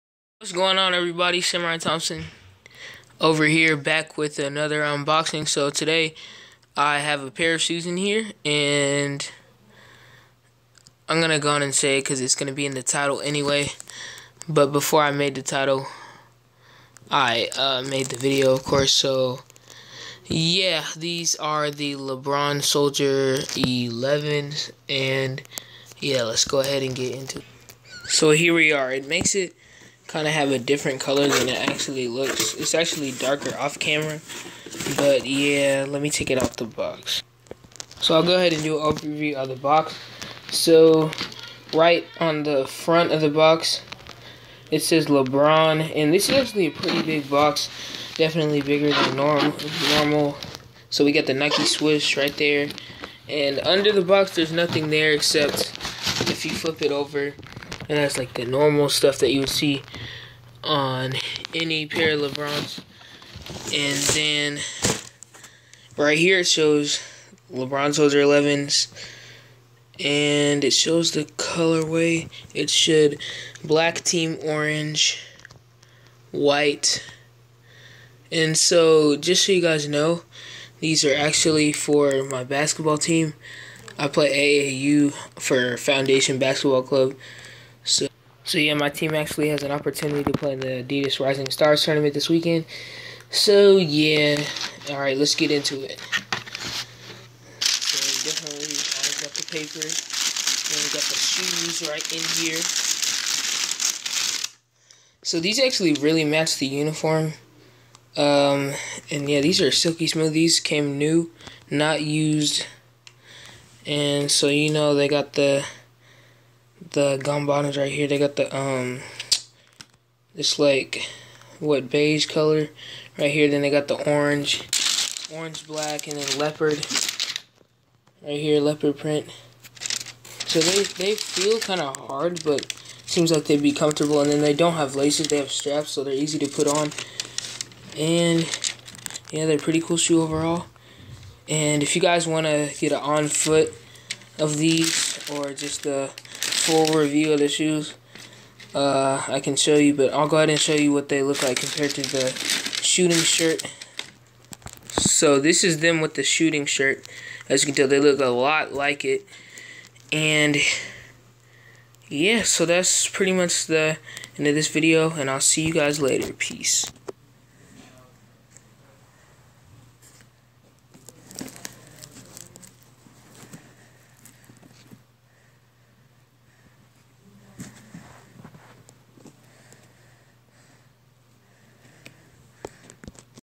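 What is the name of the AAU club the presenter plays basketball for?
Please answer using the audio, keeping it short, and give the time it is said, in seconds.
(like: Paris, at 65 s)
Foundation Basketball Club, at 85 s.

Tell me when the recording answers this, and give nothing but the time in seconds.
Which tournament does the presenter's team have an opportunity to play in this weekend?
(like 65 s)
90 s.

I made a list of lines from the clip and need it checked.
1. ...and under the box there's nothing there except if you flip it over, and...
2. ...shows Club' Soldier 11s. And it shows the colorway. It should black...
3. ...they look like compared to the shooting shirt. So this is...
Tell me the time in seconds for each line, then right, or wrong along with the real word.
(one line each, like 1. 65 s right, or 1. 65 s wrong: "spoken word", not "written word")
1. 53 s right
2. 66 s wrong: "LeBrons", not "Club"
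3. 151 s right.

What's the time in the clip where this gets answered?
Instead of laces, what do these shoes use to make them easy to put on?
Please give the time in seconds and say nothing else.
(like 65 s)
135 s.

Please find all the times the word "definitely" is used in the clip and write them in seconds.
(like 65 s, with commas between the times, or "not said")
48 s, 98 s.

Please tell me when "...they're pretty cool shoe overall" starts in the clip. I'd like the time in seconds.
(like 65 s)
139 s.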